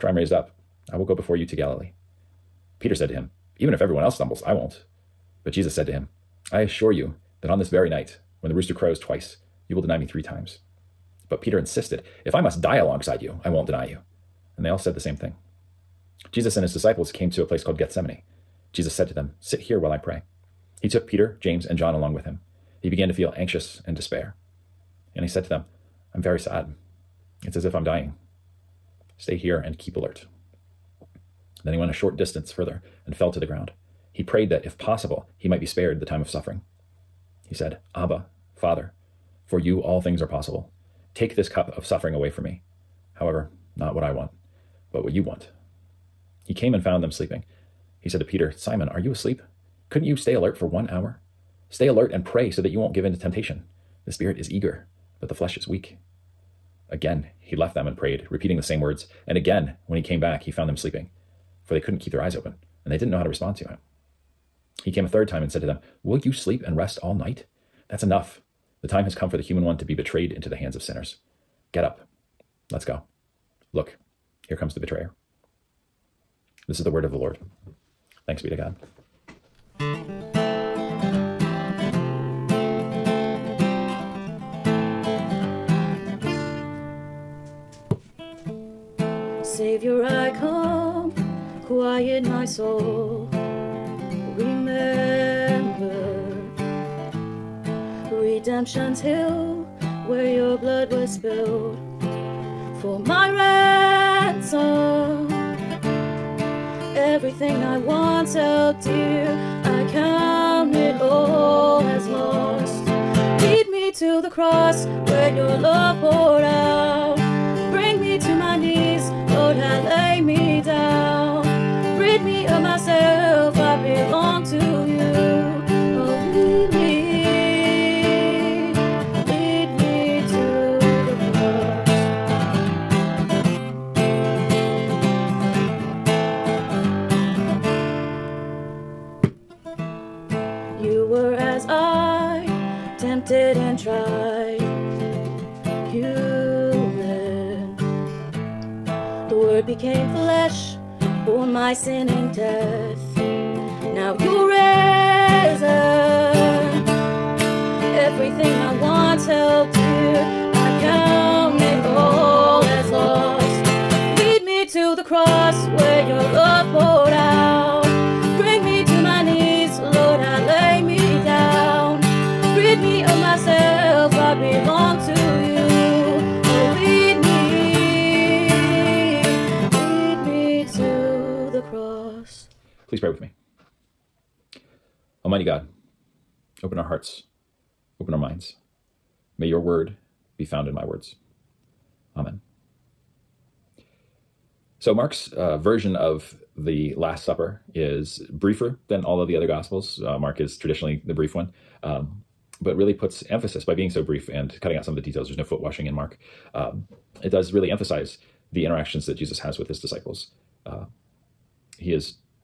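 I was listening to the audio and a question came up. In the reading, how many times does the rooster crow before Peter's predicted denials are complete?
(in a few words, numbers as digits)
2.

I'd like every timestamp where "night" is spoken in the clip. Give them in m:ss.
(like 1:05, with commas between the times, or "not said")
0:07, 1:07.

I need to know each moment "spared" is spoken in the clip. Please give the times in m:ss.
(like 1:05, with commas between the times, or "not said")
0:35.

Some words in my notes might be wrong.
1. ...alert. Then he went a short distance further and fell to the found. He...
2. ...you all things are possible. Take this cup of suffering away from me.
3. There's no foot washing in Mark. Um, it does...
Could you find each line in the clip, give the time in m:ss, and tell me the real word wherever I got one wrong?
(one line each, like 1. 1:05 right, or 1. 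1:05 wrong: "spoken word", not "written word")
1. 0:29 wrong: "ground", not "found"
2. 0:39 right
3. 3:25 right.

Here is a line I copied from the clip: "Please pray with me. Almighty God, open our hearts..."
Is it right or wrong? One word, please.
right.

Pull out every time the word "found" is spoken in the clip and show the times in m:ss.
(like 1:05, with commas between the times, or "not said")
0:46, 1:00, 3:10.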